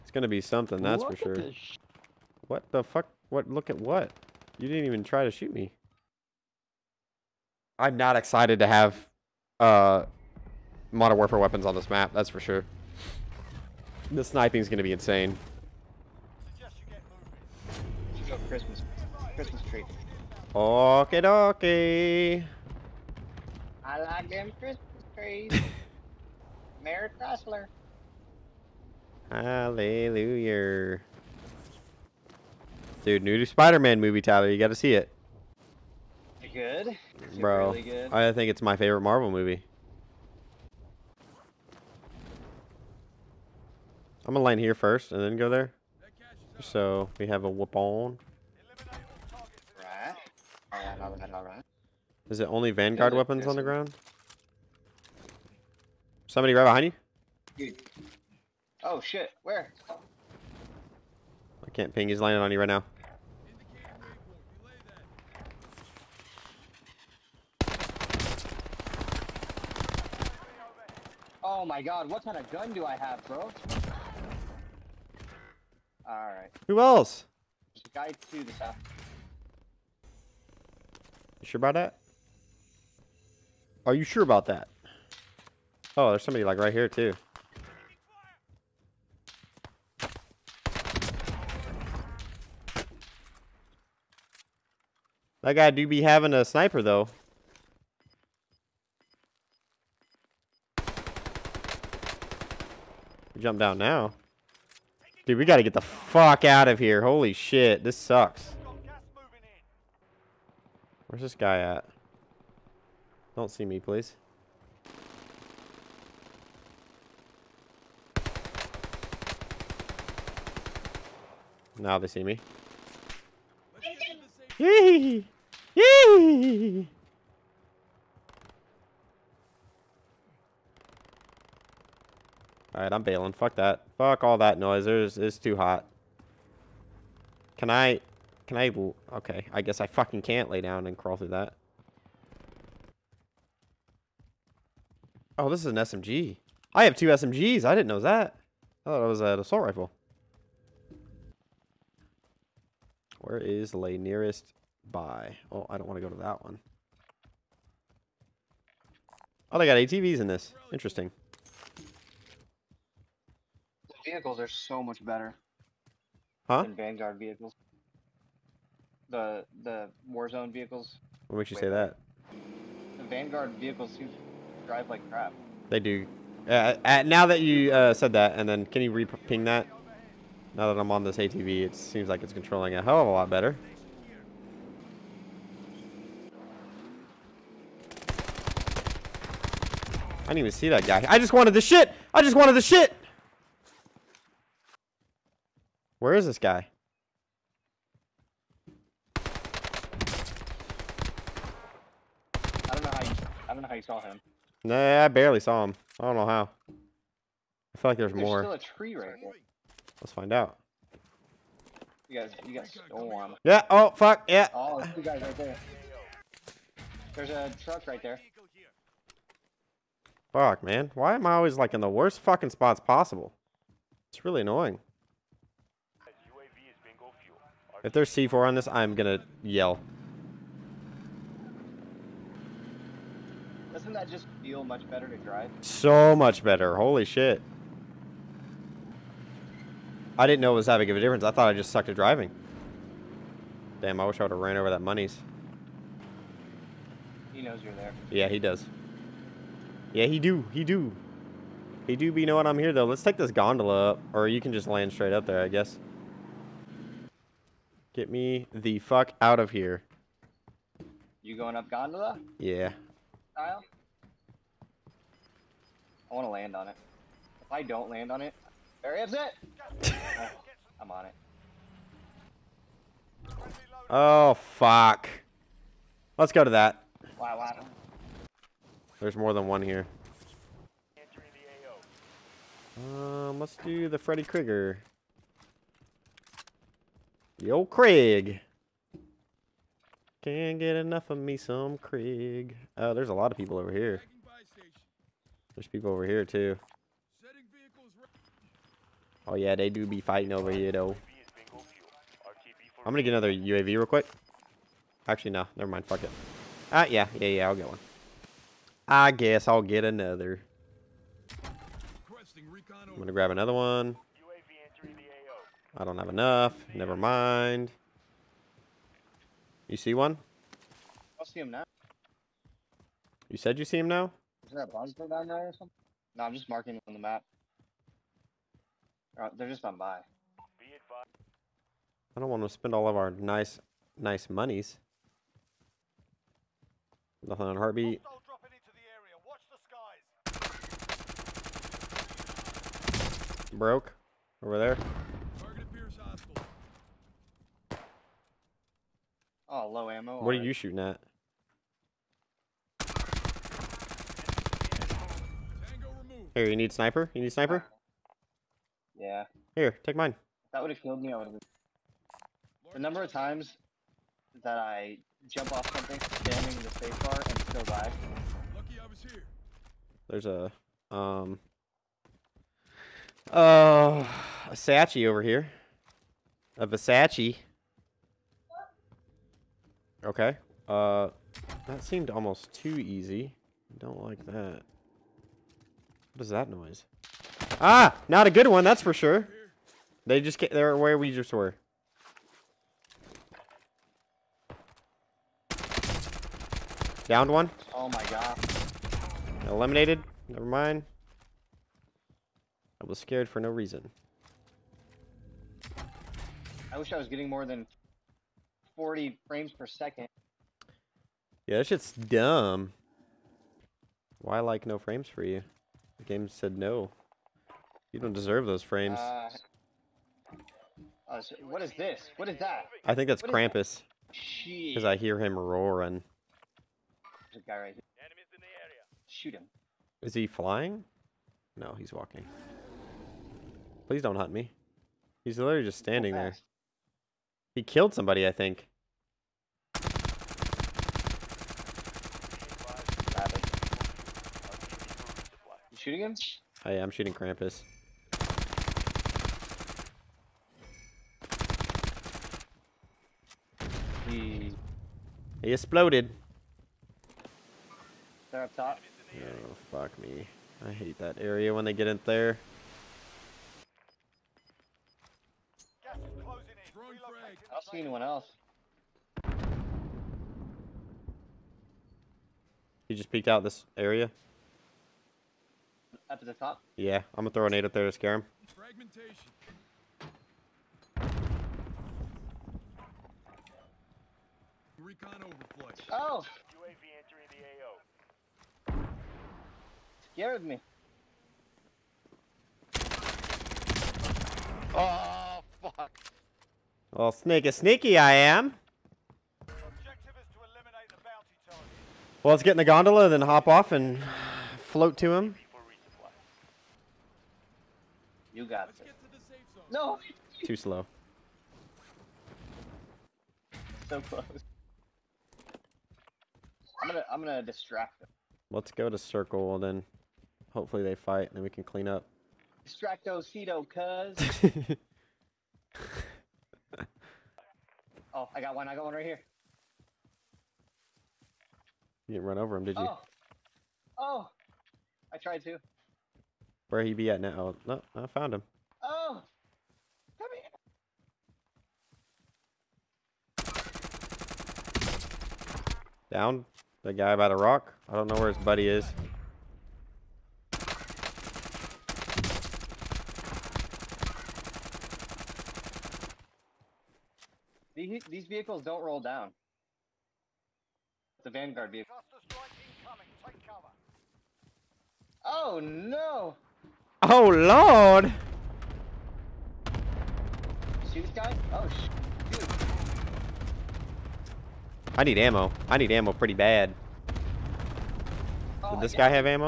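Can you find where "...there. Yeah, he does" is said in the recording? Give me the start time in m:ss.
4:07.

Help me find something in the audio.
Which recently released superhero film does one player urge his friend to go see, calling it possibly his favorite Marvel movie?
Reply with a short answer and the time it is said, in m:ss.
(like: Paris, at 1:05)
Spider-Man, at 0:33.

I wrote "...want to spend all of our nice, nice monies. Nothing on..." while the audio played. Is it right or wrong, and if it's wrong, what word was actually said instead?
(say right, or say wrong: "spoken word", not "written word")
right.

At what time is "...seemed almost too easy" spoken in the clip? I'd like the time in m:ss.
6:21.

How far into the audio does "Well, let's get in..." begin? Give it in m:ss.
8:22.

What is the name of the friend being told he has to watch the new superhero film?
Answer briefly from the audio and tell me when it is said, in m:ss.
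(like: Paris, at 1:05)
Tyler, at 0:34.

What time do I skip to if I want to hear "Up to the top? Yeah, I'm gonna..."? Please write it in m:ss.
7:56.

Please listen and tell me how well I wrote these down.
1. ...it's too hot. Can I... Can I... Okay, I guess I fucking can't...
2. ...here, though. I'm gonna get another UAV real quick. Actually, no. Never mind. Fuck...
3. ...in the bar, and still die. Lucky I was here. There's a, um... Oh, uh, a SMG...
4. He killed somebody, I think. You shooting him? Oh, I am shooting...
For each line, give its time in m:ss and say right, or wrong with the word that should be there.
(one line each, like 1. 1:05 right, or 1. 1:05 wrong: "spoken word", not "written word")
1. 2:15 right
2. 5:00 right
3. 6:05 wrong: "Sachi", not "SMG"
4. 7:17 right.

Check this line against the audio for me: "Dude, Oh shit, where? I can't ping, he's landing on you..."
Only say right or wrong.
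right.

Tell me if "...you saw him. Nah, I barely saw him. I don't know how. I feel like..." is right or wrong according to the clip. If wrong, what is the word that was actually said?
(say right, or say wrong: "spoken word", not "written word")
right.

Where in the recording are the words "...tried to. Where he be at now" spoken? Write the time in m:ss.
8:55.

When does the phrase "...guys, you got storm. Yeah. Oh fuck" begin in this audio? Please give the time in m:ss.
3:32.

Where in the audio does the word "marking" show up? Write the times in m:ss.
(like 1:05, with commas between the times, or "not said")
5:26.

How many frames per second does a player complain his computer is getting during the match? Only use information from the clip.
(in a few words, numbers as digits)
40.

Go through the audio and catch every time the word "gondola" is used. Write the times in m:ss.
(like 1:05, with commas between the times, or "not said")
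4:13, 4:21, 8:22.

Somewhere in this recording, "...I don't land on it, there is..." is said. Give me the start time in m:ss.
4:27.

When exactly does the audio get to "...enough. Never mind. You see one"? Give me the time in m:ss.
5:16.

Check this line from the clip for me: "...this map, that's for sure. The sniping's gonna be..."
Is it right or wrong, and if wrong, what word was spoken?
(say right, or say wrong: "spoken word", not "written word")
right.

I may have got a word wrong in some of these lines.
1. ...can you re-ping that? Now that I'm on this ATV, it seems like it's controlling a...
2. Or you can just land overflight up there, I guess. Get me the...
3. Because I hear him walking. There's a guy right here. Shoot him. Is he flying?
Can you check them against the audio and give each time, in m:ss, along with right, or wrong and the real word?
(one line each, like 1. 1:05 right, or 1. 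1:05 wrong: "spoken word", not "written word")
1. 2:58 right
2. 4:14 wrong: "straight", not "overflight"
3. 7:04 wrong: "roaring", not "walking".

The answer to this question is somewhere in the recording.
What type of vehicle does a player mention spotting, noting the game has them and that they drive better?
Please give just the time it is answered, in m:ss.
2:39.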